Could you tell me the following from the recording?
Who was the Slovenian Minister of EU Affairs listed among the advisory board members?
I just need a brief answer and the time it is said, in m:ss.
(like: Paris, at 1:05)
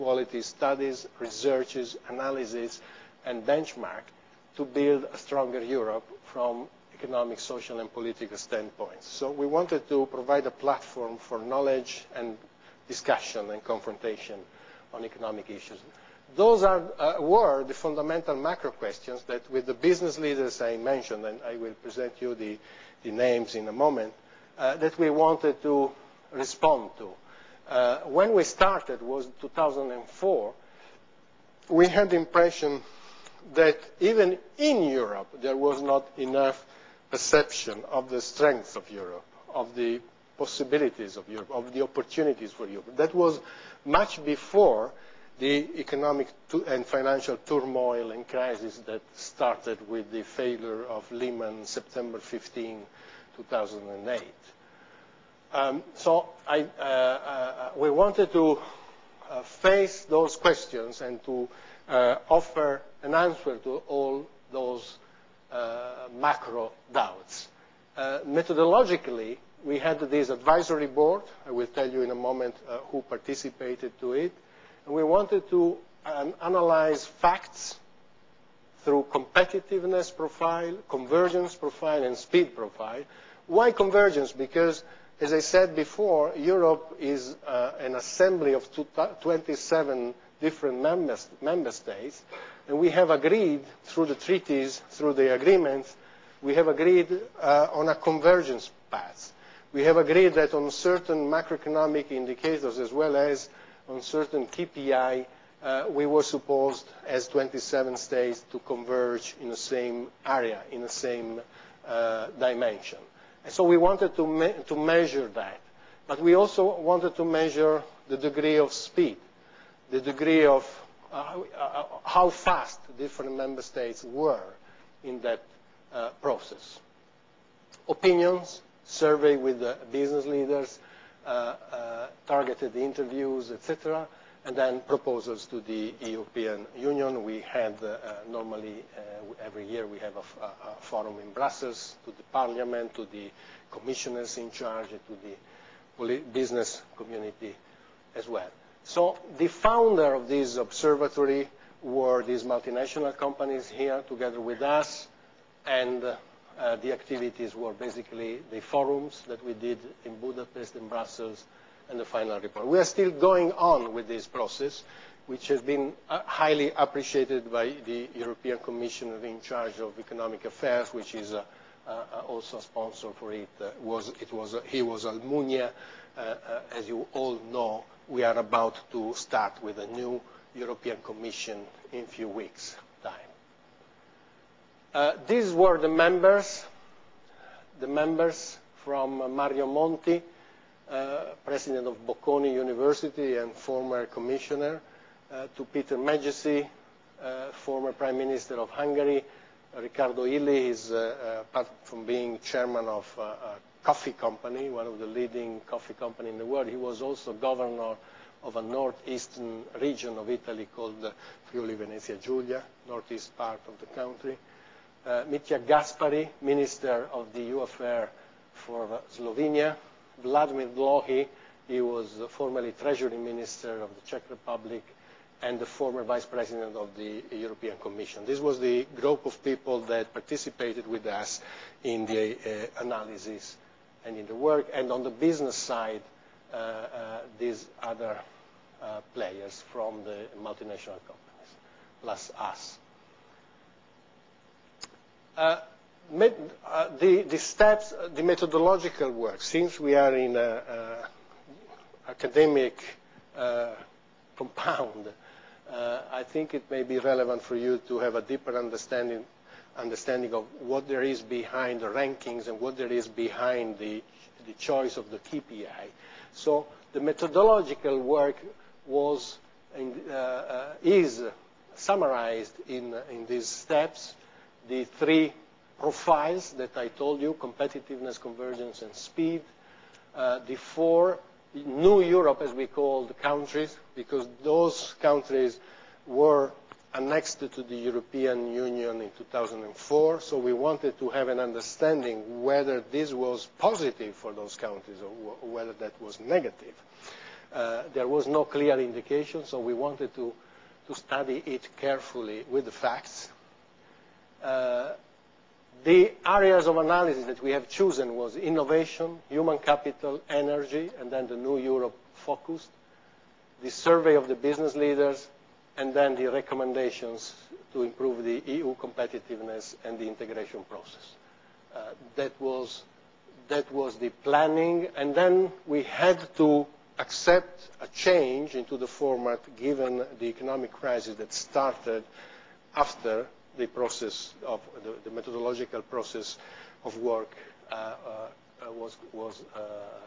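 Mitja Gaspari, at 3:35.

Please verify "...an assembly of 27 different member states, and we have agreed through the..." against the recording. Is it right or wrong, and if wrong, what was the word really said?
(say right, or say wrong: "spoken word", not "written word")
right.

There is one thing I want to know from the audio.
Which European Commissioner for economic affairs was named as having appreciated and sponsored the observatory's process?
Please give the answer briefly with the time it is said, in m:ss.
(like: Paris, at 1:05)
Almunia, at 2:55.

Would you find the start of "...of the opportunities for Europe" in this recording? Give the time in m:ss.
0:41.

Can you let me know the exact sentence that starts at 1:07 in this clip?
Methodologically, we had this advisory board, I will tell you in a moment who participated to it.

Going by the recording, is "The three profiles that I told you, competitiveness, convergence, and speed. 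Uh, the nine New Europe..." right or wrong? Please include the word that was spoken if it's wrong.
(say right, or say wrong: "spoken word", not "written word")
wrong: "four", not "nine".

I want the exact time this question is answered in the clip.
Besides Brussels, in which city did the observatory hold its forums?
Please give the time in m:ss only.
2:40.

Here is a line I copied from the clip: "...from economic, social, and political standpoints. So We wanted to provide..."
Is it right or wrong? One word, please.
right.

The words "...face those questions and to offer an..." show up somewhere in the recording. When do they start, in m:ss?
0:59.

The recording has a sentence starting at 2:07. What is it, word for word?
Opinions, survey with the business leaders, targeted interviews, etc.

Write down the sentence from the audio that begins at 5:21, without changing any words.
Uh, that, was, that was the planning.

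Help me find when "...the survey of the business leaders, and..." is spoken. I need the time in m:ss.
5:13.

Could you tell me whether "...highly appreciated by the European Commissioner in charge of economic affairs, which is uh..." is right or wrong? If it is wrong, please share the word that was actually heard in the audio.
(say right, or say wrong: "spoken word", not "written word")
right.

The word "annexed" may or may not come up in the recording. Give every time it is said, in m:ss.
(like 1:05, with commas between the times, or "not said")
4:46.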